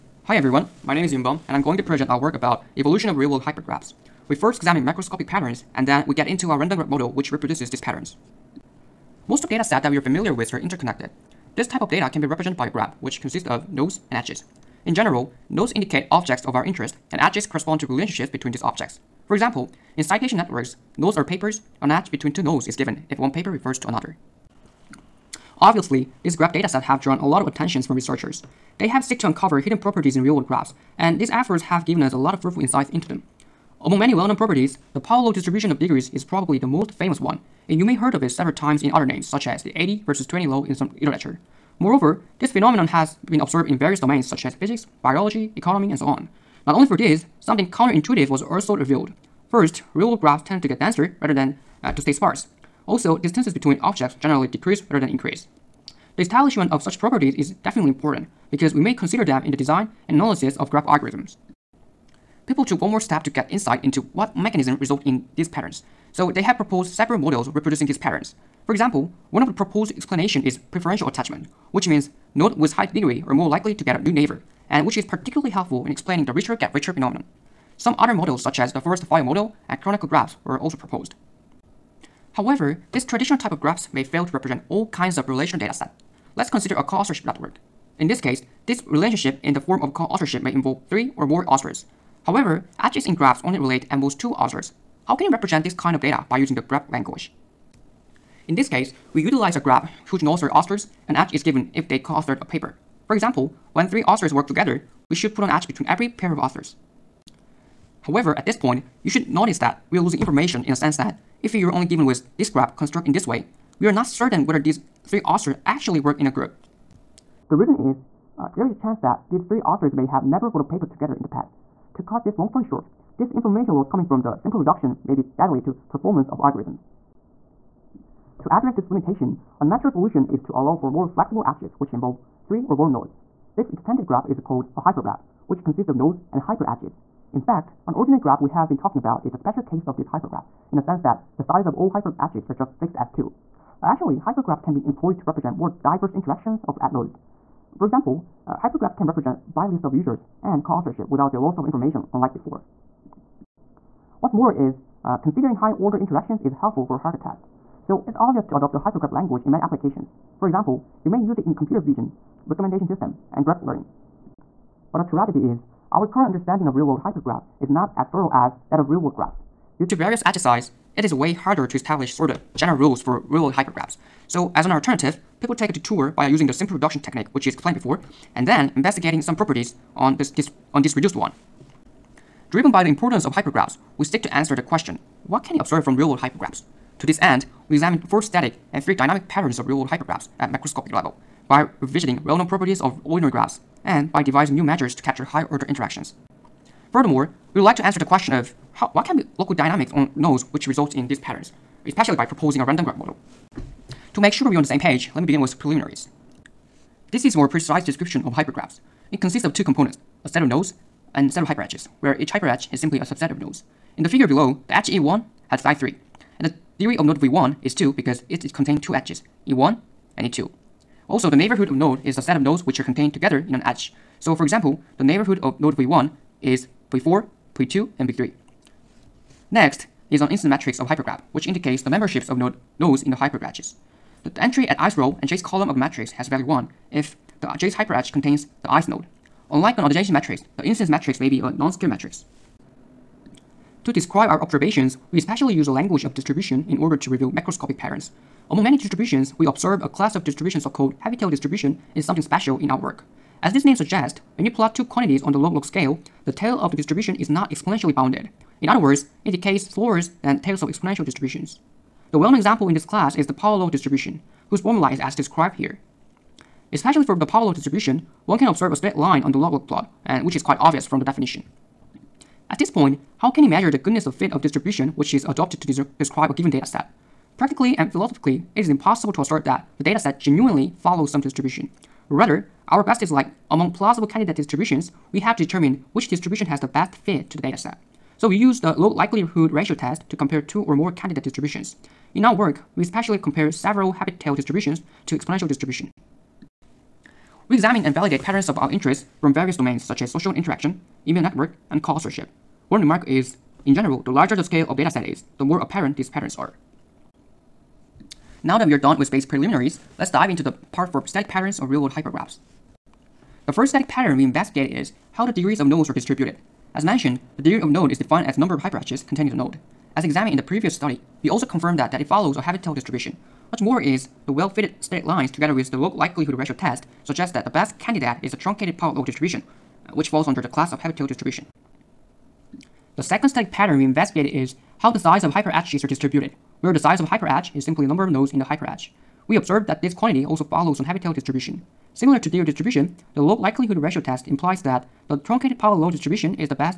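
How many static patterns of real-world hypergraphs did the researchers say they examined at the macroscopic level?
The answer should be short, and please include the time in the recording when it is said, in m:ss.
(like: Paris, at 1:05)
4, at 3:08.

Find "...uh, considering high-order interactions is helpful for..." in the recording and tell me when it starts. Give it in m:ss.
2:35.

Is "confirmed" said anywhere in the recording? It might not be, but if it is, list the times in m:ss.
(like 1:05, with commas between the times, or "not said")
5:21.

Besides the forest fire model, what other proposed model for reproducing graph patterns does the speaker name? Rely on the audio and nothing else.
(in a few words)
Kronecker graphs.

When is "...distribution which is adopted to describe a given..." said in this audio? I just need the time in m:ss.
4:34.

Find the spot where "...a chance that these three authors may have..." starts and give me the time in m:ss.
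1:58.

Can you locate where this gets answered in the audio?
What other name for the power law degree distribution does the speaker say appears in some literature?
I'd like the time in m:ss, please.
0:39.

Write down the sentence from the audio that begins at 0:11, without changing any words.
This type of data can be represented by a graph which consists of nodes and edges.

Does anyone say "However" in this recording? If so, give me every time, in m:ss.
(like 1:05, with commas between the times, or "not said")
1:22, 1:32, 1:48.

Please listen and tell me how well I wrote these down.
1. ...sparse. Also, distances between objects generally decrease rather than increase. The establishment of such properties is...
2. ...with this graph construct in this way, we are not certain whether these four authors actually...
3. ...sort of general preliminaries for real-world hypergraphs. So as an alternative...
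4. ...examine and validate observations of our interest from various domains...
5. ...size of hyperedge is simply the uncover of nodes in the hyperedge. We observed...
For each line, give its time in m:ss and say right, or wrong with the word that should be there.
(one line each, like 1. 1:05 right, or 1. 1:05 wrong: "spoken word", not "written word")
1. 0:52 right
2. 1:52 wrong: "three", not "four"
3. 2:52 wrong: "rules", not "preliminaries"
4. 4:57 wrong: "patterns", not "observations"
5. 5:36 wrong: "number", not "uncover".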